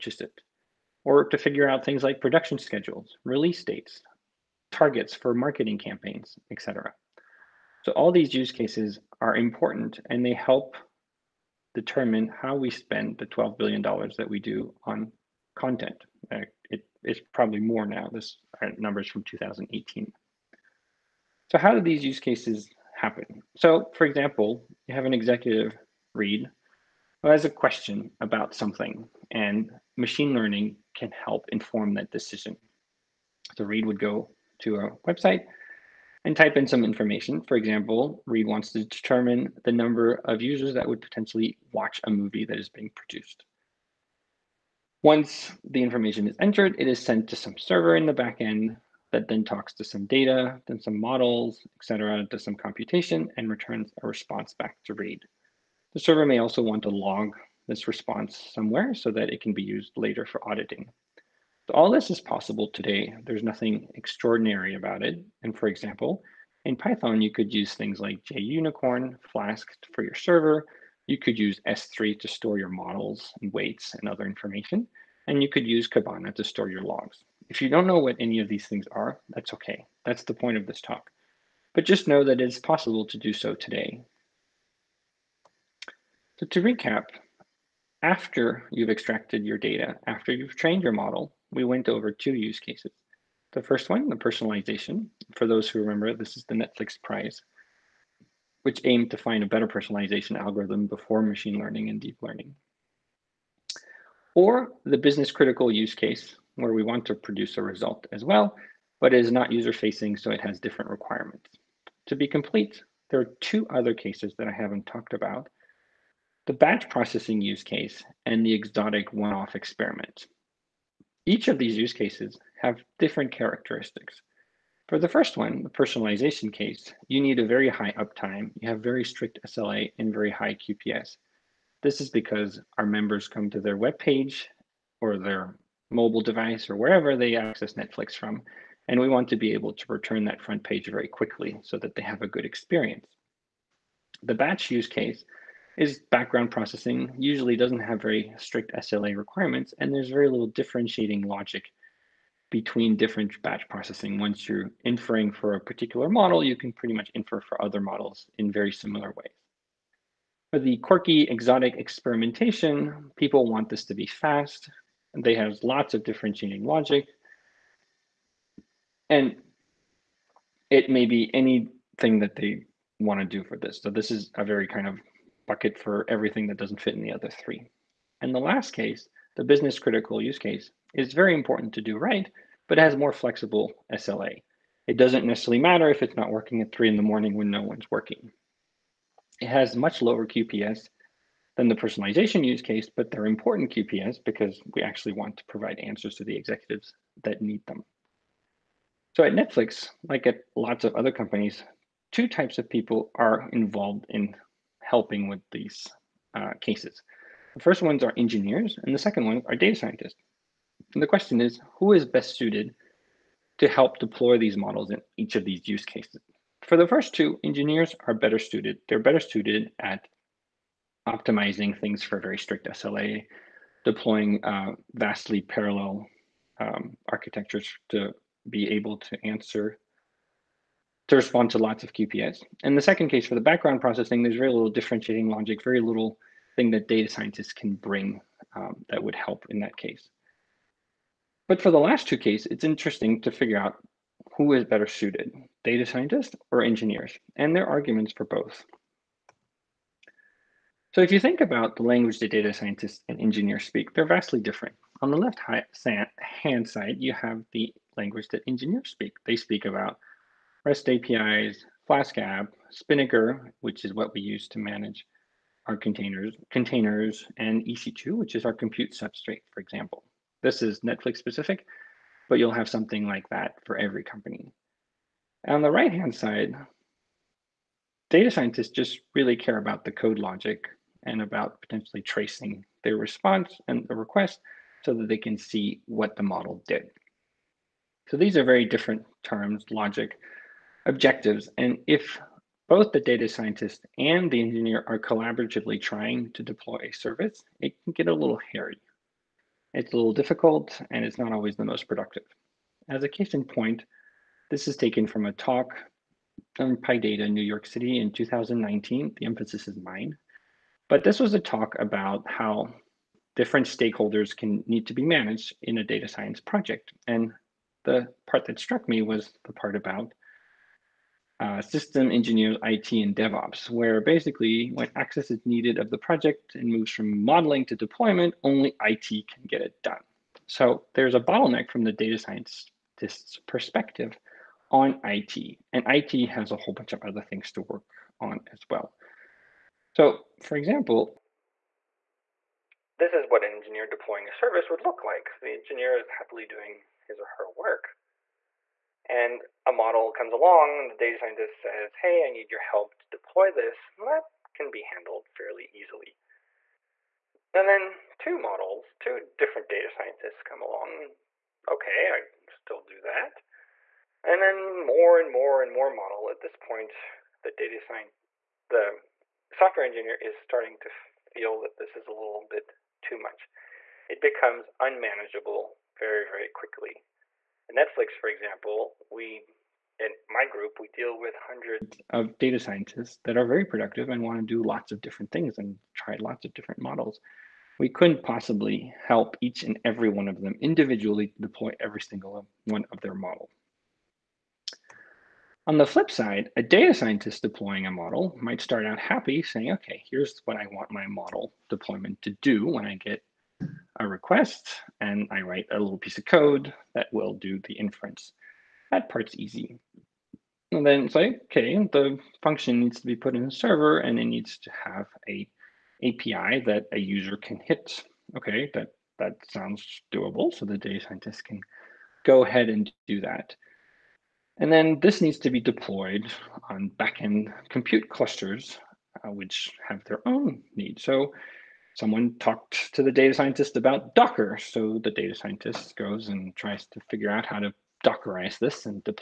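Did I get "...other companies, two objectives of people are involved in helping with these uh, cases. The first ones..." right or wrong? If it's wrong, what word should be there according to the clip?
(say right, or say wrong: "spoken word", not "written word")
wrong: "types", not "objectives".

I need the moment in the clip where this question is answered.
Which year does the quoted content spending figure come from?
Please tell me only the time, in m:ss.
0:19.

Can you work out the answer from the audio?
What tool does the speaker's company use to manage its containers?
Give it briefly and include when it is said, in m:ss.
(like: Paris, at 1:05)
Spinnaker, at 4:22.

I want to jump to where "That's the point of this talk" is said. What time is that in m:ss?
1:20.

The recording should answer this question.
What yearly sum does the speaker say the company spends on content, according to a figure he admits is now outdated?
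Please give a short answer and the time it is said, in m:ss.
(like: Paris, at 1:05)
$12 billion, at 0:13.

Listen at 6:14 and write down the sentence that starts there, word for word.
It becomes unmanageable very, very quickly.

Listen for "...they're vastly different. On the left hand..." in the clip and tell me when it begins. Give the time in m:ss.
4:13.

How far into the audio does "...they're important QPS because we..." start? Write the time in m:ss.
3:13.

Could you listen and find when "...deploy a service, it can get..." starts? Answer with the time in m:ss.
4:56.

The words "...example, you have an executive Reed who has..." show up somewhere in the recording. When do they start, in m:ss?
0:24.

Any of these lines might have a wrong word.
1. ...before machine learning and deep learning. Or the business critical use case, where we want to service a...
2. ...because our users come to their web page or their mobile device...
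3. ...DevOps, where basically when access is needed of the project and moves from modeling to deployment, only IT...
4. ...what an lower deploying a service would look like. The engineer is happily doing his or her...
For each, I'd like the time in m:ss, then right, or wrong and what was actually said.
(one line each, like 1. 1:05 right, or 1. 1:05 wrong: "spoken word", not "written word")
1. 1:40 wrong: "produce", not "service"
2. 2:12 wrong: "members", not "users"
3. 5:23 right
4. 5:43 wrong: "engineer", not "lower".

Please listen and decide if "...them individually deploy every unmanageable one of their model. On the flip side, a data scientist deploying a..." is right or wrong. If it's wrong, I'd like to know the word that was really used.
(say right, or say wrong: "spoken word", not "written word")
wrong: "single", not "unmanageable".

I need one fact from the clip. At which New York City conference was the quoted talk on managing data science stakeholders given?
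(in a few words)
PyData.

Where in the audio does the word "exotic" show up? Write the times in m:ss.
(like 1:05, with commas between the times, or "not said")
1:58, 2:41.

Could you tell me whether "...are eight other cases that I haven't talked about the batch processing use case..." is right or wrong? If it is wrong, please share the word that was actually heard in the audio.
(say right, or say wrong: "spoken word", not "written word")
wrong: "two", not "eight".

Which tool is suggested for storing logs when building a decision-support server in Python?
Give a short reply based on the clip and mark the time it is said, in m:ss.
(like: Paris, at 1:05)
Kibana, at 1:15.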